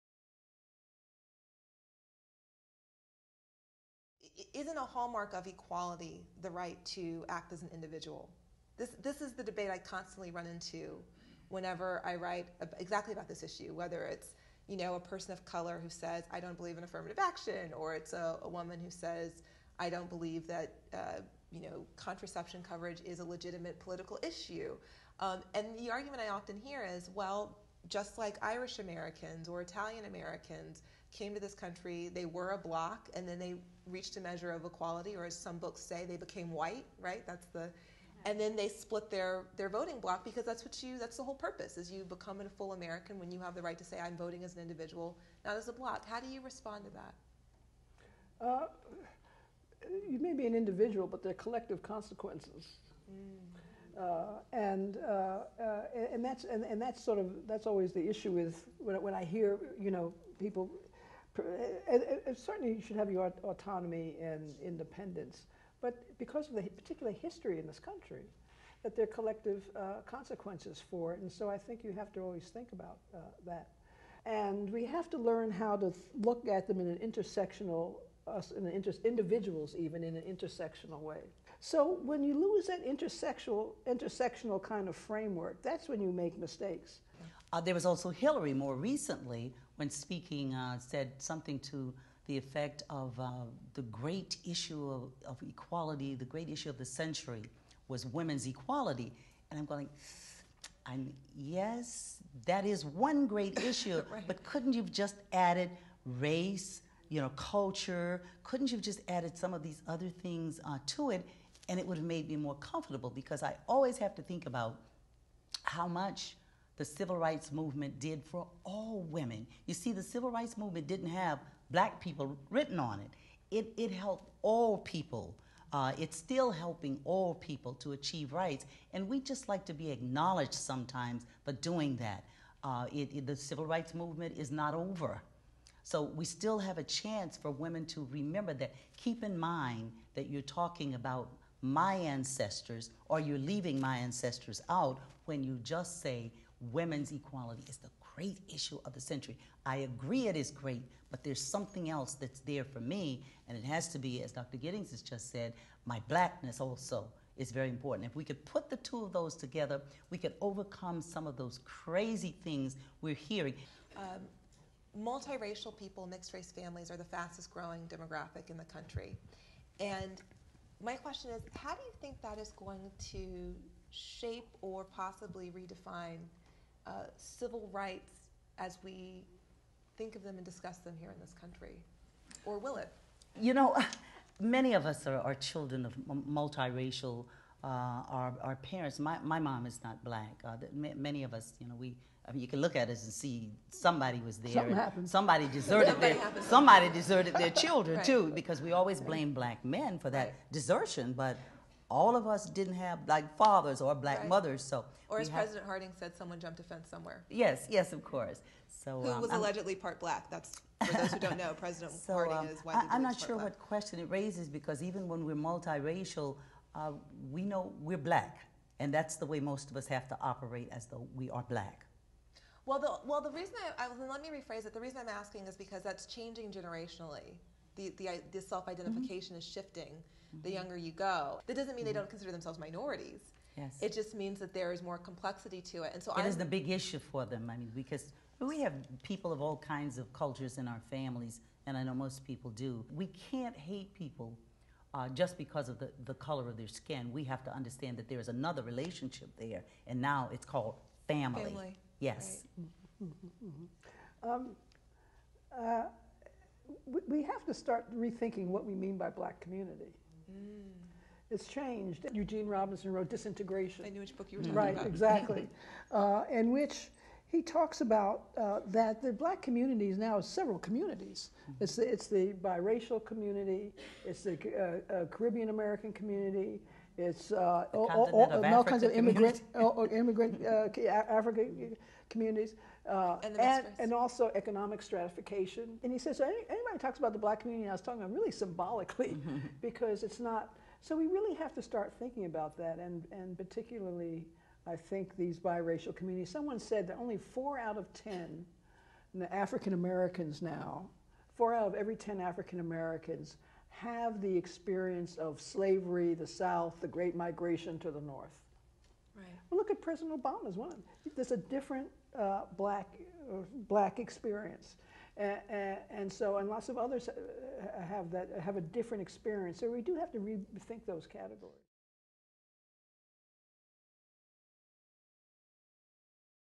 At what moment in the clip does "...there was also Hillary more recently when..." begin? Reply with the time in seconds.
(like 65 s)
87 s.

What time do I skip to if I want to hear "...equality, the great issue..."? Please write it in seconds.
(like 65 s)
95 s.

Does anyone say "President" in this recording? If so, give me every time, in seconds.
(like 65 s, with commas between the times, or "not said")
205 s, 211 s, 309 s.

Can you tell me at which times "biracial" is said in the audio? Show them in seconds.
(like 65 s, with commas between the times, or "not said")
272 s, 295 s.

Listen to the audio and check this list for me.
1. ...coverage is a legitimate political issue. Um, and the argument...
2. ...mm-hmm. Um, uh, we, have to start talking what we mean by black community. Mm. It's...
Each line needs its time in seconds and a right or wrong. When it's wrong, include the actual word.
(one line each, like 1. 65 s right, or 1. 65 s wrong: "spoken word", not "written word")
1. 22 s right
2. 253 s wrong: "rethinking", not "talking".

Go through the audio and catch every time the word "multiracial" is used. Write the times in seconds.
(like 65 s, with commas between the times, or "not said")
164 s, 186 s, 215 s.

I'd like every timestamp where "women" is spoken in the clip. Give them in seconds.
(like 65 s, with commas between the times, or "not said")
98 s, 119 s, 137 s, 146 s.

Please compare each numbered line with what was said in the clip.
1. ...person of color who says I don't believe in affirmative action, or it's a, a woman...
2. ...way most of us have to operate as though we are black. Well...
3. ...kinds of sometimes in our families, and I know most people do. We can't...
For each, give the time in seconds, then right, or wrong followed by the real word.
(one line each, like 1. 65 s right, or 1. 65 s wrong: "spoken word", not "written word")
1. 14 s right
2. 219 s right
3. 239 s wrong: "cultures", not "sometimes".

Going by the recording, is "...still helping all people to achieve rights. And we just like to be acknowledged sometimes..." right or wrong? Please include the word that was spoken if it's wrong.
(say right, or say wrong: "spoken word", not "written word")
right.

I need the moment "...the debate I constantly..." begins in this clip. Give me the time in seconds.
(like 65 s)
9 s.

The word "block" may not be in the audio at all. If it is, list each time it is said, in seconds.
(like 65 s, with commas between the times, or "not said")
32 s, 39 s, 45 s.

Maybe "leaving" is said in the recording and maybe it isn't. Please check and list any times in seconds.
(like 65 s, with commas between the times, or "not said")
143 s.